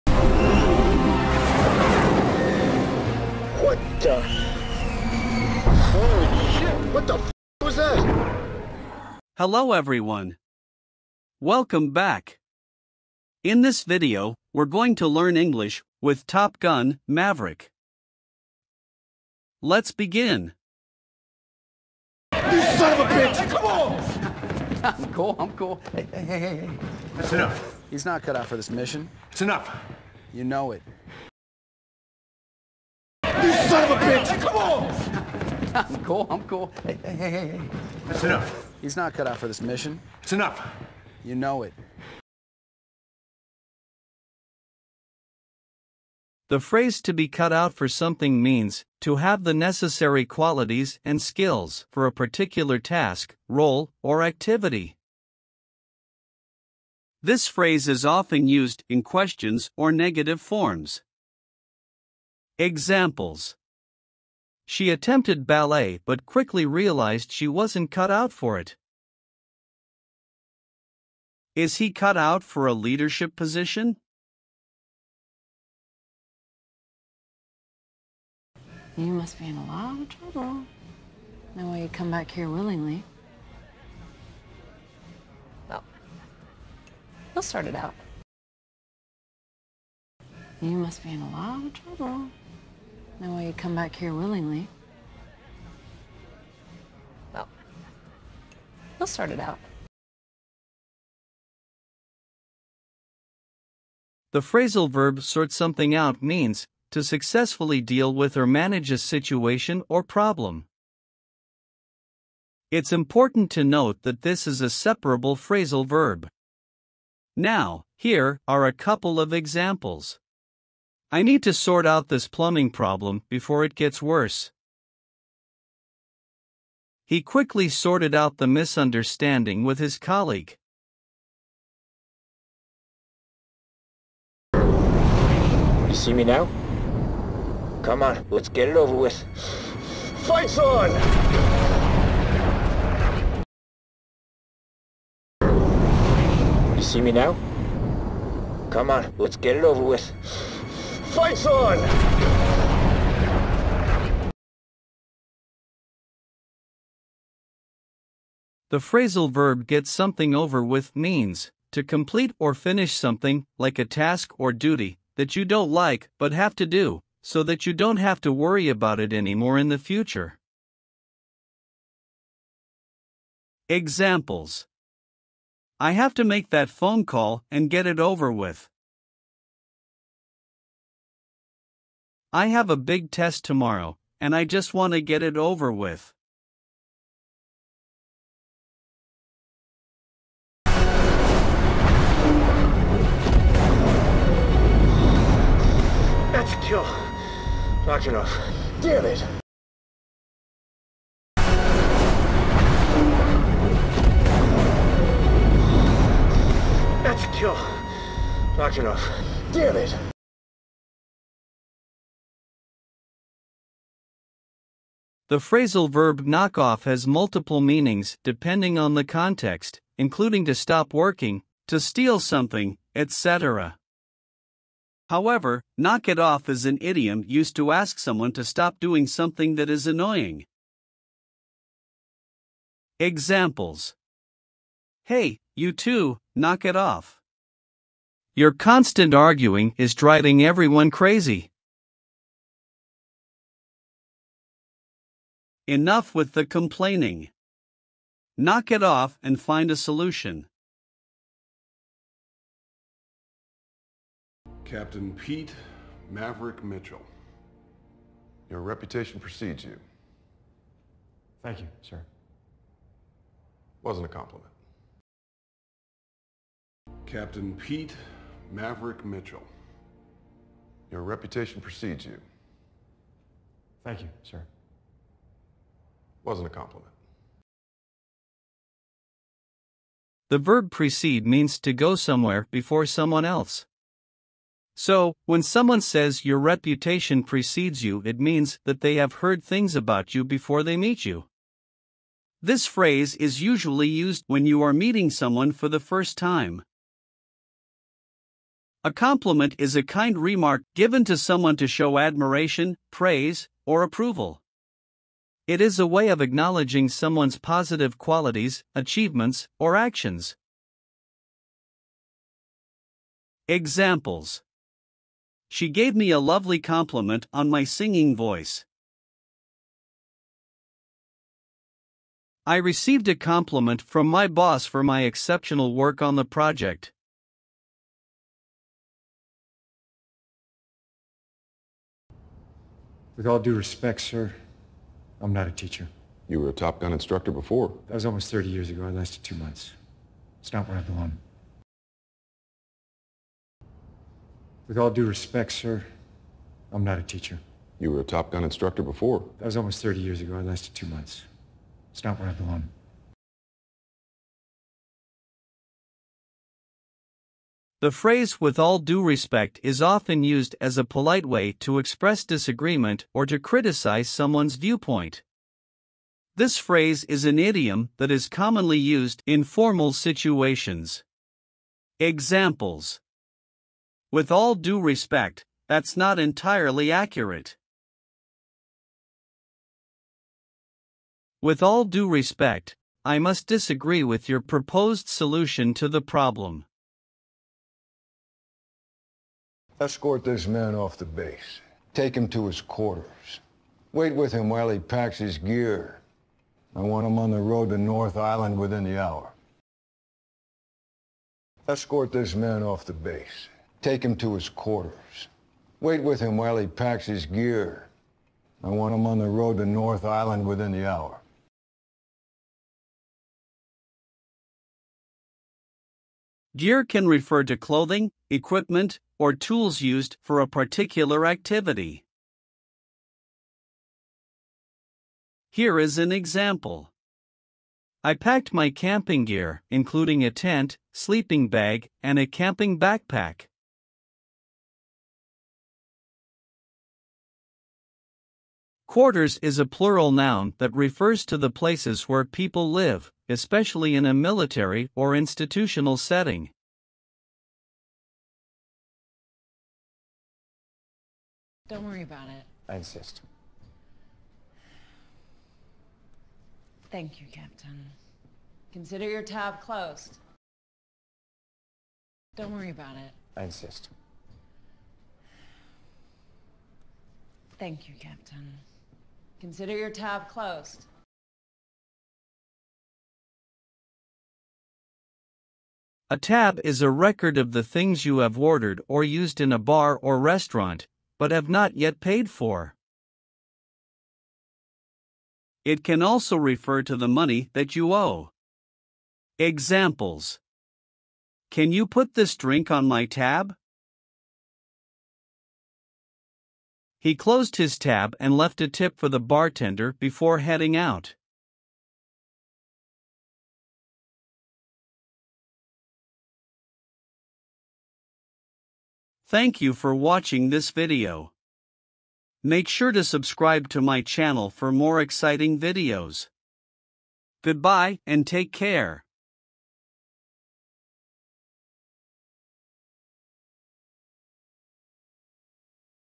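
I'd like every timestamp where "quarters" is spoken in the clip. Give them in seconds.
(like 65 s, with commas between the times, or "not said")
392 s, 404 s, 438 s.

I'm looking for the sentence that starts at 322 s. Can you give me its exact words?
I received a compliment from my boss for my exceptional work on the project.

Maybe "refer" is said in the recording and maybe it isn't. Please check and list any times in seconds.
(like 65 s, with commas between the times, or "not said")
417 s, 440 s, 486 s.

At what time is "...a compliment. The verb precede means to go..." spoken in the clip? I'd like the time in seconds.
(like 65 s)
276 s.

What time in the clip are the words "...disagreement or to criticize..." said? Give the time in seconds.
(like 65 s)
362 s.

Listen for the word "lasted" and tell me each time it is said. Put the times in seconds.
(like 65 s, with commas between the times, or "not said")
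338 s, 350 s.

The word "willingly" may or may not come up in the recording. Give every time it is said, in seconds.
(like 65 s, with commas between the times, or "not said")
82 s, 94 s.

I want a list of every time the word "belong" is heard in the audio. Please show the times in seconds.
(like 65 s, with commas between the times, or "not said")
340 s, 352 s.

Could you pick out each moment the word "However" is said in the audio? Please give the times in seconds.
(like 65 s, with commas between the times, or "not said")
225 s.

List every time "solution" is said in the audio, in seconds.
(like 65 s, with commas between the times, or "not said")
249 s, 385 s.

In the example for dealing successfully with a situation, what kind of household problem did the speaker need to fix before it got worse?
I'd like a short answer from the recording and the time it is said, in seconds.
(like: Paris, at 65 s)
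plumbing problem, at 122 s.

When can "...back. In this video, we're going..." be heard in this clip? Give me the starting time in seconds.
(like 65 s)
11 s.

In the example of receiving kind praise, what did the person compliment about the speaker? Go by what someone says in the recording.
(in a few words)
singing voice.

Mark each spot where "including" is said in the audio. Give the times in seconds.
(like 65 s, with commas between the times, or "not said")
219 s, 429 s.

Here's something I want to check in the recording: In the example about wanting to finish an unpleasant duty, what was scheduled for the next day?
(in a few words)
a big test.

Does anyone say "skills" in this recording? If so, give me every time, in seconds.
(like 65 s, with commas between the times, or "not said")
51 s.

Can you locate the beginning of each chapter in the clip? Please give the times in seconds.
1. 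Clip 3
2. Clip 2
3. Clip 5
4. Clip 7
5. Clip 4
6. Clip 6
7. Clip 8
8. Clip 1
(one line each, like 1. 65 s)
1. 134 s
2. 78 s
3. 253 s
4. 389 s
5. 190 s
6. 331 s
7. 450 s
8. 22 s.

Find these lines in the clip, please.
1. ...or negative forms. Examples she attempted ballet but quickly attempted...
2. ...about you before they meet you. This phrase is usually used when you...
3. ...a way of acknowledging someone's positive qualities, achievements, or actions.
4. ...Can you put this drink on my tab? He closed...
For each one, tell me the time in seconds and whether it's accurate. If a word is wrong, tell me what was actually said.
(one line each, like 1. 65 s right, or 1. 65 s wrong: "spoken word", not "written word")
1. 59 s wrong: "realized", not "attempted"
2. 289 s right
3. 305 s right
4. 491 s right.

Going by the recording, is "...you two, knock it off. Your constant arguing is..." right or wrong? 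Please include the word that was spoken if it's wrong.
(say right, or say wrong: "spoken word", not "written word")
right.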